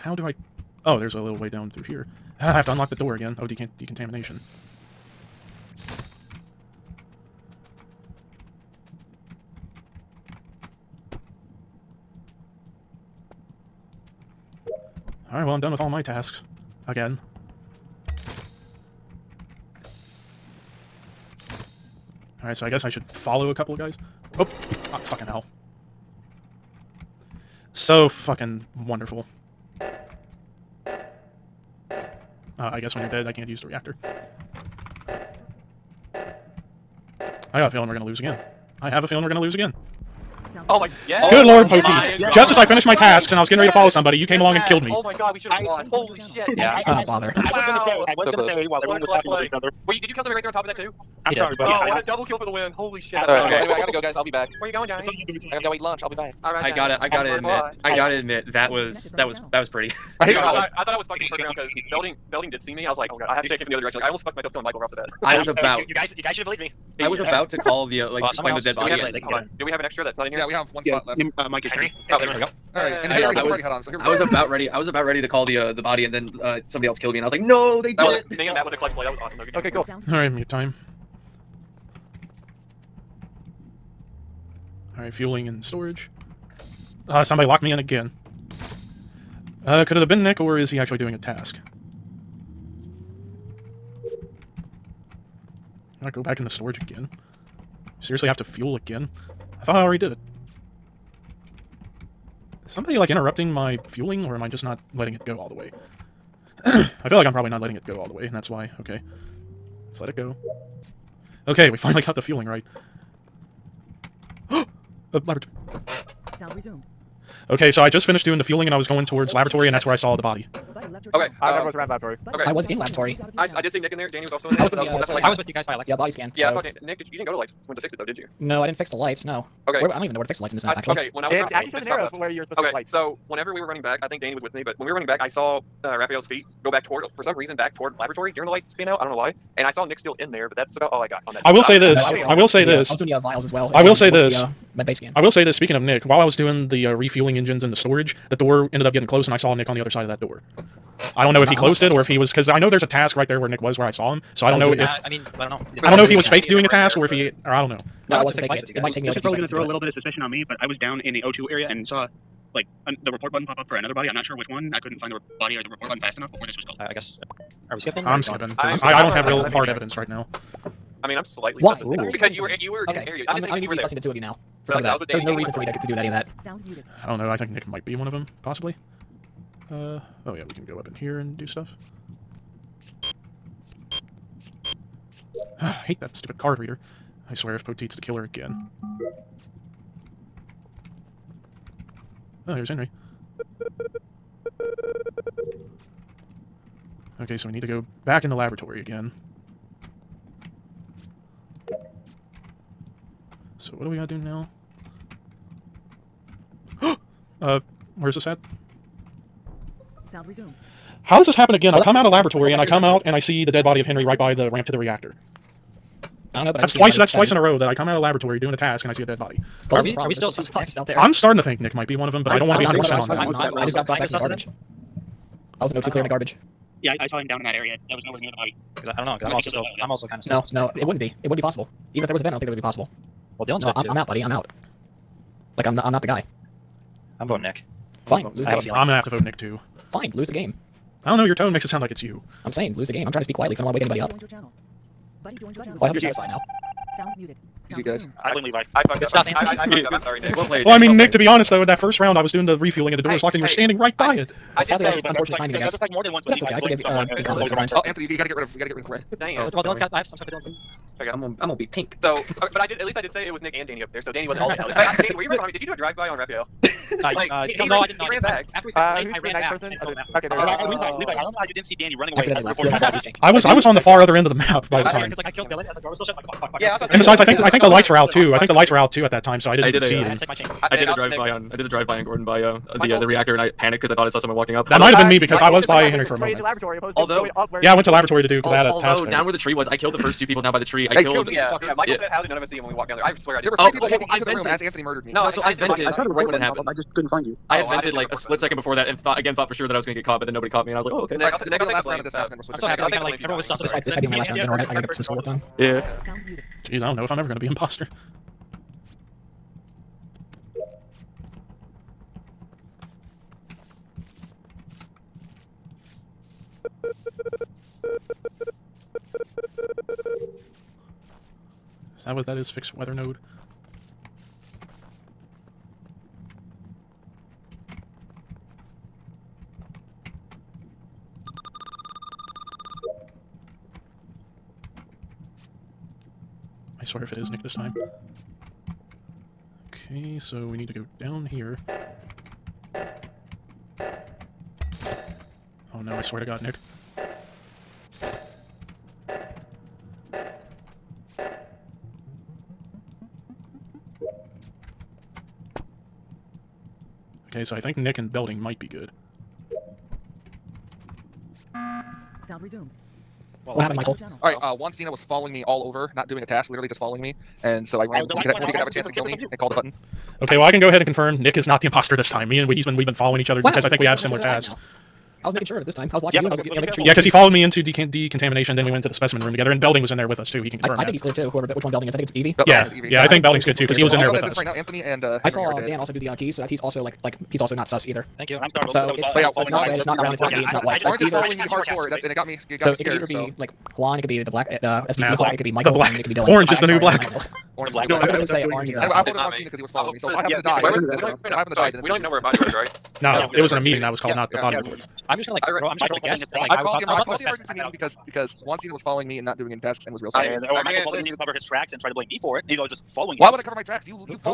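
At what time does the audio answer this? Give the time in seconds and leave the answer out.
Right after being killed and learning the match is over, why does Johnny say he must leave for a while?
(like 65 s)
55 s.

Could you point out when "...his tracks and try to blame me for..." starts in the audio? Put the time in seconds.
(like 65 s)
411 s.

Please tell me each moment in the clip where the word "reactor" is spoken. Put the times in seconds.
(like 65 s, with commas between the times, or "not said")
33 s, 214 s, 283 s.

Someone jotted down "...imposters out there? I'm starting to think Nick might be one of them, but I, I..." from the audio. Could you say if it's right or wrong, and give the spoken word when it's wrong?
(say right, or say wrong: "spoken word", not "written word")
right.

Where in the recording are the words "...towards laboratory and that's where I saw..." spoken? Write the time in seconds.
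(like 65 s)
119 s.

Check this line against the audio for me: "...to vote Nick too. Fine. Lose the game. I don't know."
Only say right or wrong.
right.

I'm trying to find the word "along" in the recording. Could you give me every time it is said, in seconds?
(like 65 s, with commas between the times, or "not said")
44 s.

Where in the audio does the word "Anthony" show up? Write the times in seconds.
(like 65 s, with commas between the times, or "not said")
249 s, 257 s, 294 s, 384 s.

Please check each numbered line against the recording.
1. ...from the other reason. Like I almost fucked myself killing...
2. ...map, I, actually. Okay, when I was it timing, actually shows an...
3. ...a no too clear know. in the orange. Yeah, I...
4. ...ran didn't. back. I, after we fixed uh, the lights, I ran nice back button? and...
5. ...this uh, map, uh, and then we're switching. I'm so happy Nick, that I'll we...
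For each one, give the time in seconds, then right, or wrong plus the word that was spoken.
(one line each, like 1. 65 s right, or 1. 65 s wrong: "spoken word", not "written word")
1. 63 s wrong: "direction", not "reason"
2. 130 s wrong: "running", not "timing"
3. 225 s wrong: "garbage", not "orange"
4. 268 s wrong: "person", not "button"
5. 302 s right.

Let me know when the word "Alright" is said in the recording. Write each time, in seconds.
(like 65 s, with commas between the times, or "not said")
15 s, 22 s, 84 s.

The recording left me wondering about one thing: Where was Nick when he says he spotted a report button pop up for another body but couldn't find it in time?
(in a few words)
O2 area.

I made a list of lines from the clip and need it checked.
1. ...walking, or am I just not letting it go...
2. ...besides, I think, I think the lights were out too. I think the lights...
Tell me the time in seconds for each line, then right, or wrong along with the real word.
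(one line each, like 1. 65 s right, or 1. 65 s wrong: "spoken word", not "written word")
1. 103 s wrong: "fueling", not "walking"
2. 276 s right.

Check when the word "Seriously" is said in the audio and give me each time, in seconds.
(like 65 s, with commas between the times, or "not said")
98 s.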